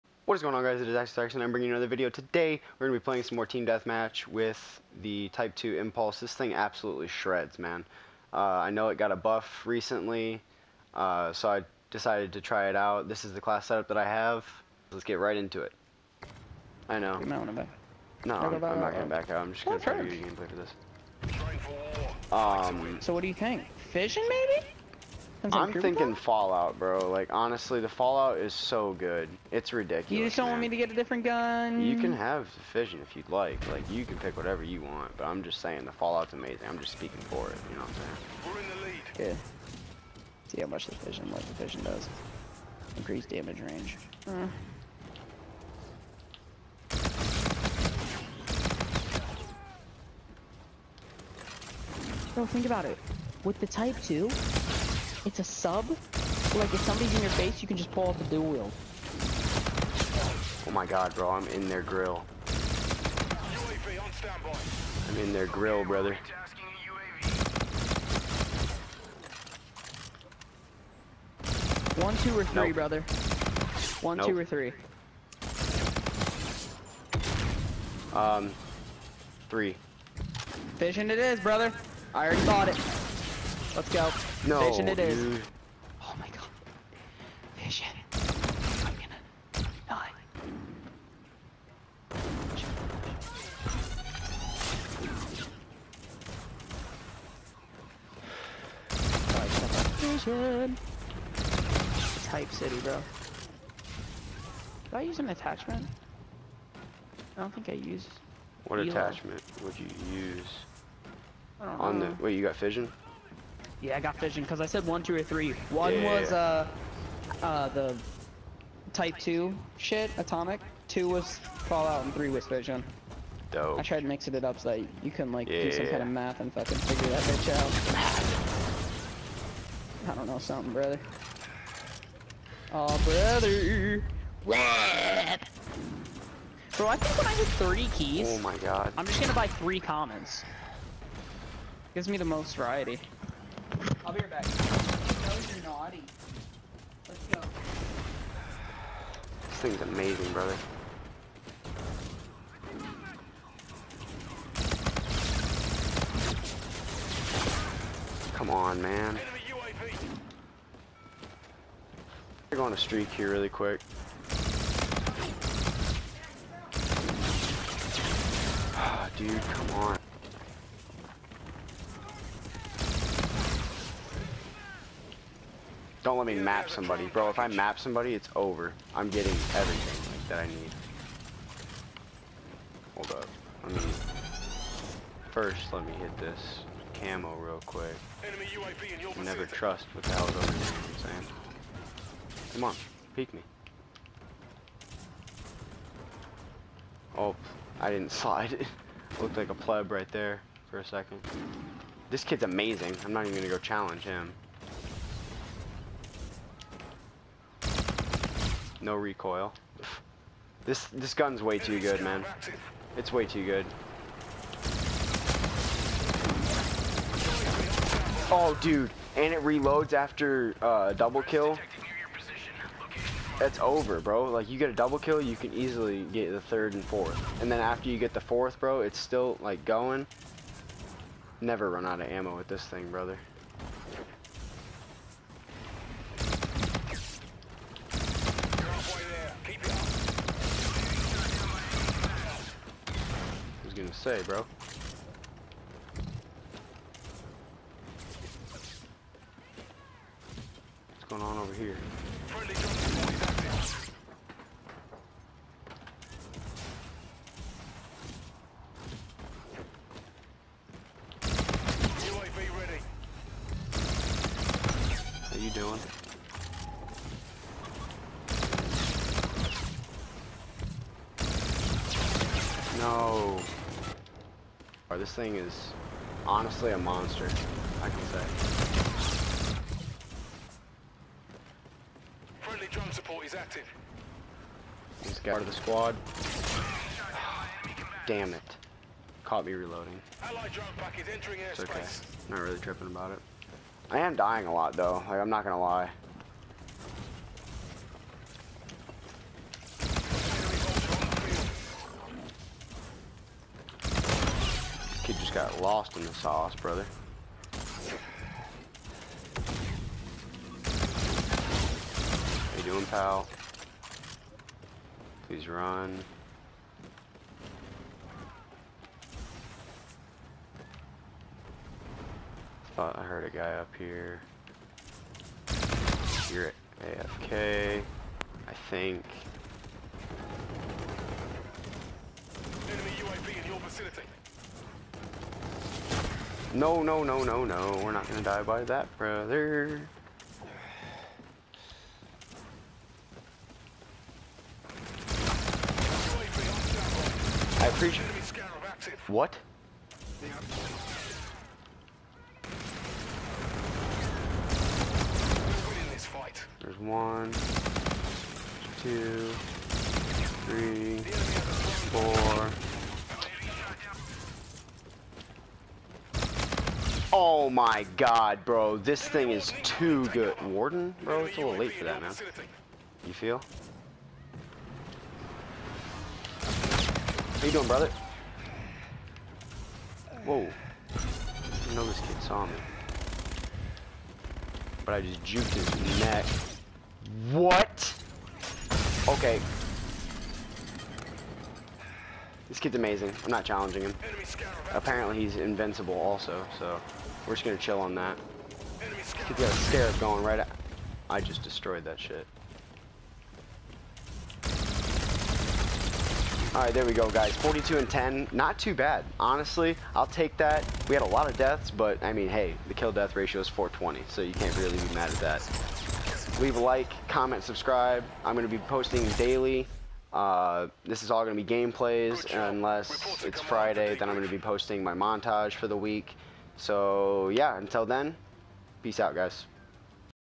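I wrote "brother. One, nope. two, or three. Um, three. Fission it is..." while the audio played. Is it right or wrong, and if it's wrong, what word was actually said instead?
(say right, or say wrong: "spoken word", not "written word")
right.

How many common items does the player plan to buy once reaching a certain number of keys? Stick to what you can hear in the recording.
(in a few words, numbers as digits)
3.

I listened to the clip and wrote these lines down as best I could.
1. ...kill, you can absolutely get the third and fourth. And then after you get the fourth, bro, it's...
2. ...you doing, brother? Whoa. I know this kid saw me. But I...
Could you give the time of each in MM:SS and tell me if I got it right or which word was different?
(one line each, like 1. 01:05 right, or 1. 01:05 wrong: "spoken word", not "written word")
1. 03:44 wrong: "easily", not "absolutely"
2. 06:17 right.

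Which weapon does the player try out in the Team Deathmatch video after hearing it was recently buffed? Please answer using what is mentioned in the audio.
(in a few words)
Type 2 Impulse.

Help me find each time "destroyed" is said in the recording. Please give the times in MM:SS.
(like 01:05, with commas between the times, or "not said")
06:41.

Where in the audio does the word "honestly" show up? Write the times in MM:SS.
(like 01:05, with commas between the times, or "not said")
00:27, 04:36, 06:49.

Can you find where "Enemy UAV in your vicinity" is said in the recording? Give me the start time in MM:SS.
05:32.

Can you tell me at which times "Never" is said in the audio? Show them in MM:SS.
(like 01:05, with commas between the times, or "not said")
03:09, 03:51.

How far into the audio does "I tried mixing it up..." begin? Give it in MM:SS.
02:03.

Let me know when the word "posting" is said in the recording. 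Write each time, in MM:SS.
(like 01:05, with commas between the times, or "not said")
06:58, 07:04.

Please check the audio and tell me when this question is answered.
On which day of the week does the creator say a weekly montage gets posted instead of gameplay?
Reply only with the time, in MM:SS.
07:03.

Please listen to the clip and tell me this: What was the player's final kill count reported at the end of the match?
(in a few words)
42.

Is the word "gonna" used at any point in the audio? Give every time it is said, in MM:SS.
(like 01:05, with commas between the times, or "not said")
01:28, 02:19, 03:23, 04:55, 05:38, 06:37.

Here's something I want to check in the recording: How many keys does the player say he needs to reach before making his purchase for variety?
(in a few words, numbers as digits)
30.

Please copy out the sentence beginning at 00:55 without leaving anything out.
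Like if somebody's in your face, you can just pull off the dual wheel.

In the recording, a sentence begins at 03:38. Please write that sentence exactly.
Oh, dude, and it reloads after uh, a double kill.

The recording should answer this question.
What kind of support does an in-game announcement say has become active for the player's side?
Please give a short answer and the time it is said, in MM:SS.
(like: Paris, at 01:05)
Friendly drone support, at 04:42.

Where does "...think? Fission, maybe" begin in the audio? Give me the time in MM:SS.
00:23.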